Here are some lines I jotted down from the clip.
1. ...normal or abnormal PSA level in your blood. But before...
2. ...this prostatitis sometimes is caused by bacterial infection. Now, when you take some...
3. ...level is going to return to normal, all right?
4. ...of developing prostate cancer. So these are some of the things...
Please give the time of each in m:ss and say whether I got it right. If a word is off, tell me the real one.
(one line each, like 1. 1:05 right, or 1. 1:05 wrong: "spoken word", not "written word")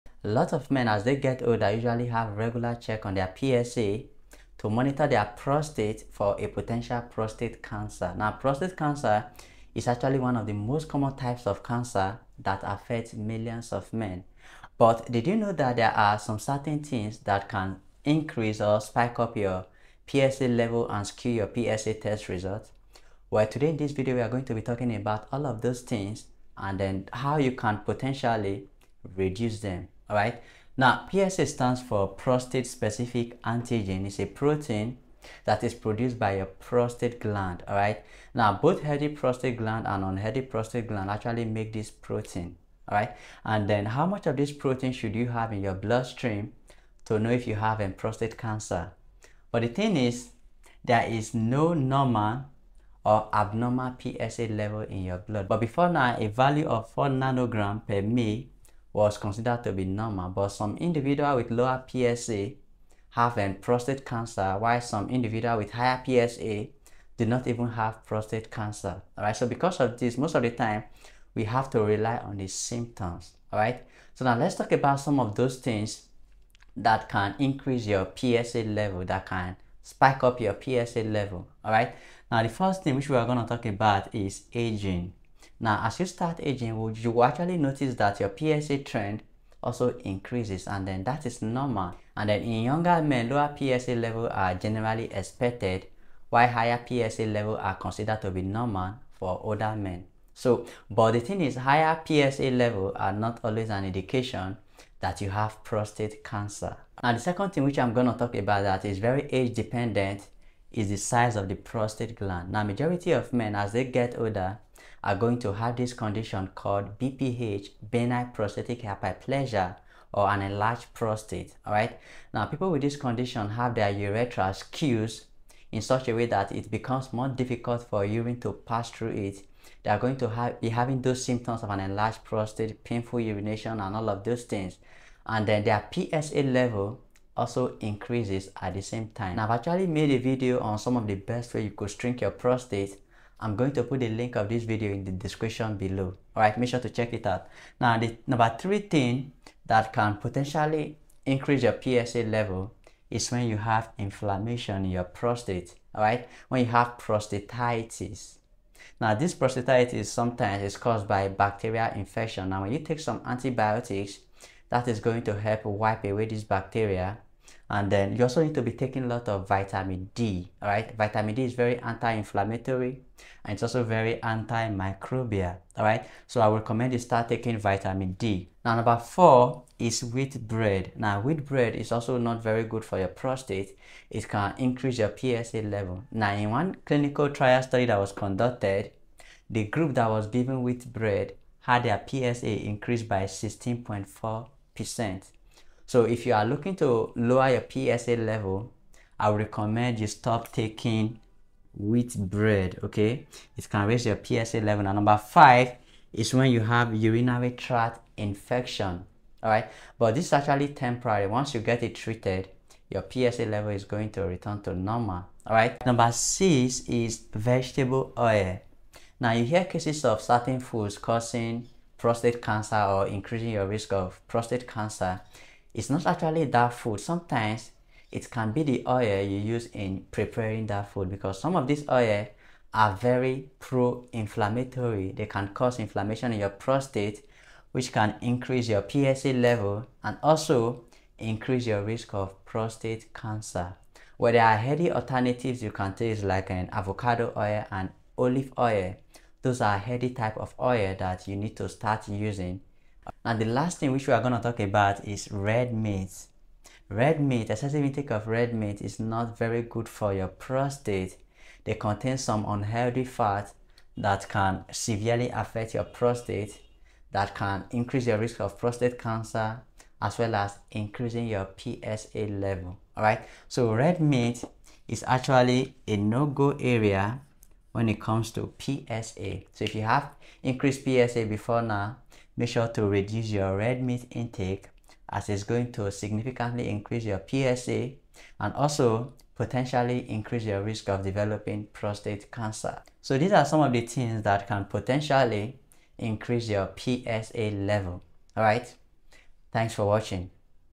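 1. 0:51 right
2. 2:39 right
3. 3:33 right
4. 4:50 right.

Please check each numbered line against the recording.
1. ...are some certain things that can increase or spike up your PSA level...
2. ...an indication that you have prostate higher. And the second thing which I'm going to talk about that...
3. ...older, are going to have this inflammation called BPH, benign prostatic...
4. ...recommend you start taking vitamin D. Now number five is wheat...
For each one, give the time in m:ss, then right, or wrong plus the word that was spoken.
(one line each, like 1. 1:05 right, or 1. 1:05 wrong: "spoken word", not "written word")
1. 0:15 right
2. 1:43 wrong: "cancer", not "higher"
3. 1:54 wrong: "condition", not "inflammation"
4. 2:56 wrong: "four", not "five".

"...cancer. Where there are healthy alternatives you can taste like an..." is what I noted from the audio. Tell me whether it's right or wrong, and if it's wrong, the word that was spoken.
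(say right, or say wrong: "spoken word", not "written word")
right.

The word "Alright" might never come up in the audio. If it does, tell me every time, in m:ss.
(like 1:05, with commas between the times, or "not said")
2:26, 2:35, 4:32.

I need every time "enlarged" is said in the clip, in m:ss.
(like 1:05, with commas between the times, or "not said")
2:00, 2:11.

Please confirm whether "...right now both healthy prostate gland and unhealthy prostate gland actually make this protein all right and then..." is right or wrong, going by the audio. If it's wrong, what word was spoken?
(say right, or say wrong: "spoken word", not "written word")
right.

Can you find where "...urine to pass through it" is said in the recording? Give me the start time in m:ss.
2:08.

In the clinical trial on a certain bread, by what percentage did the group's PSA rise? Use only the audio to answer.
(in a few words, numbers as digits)
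16.4%.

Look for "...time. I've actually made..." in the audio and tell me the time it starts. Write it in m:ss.
2:19.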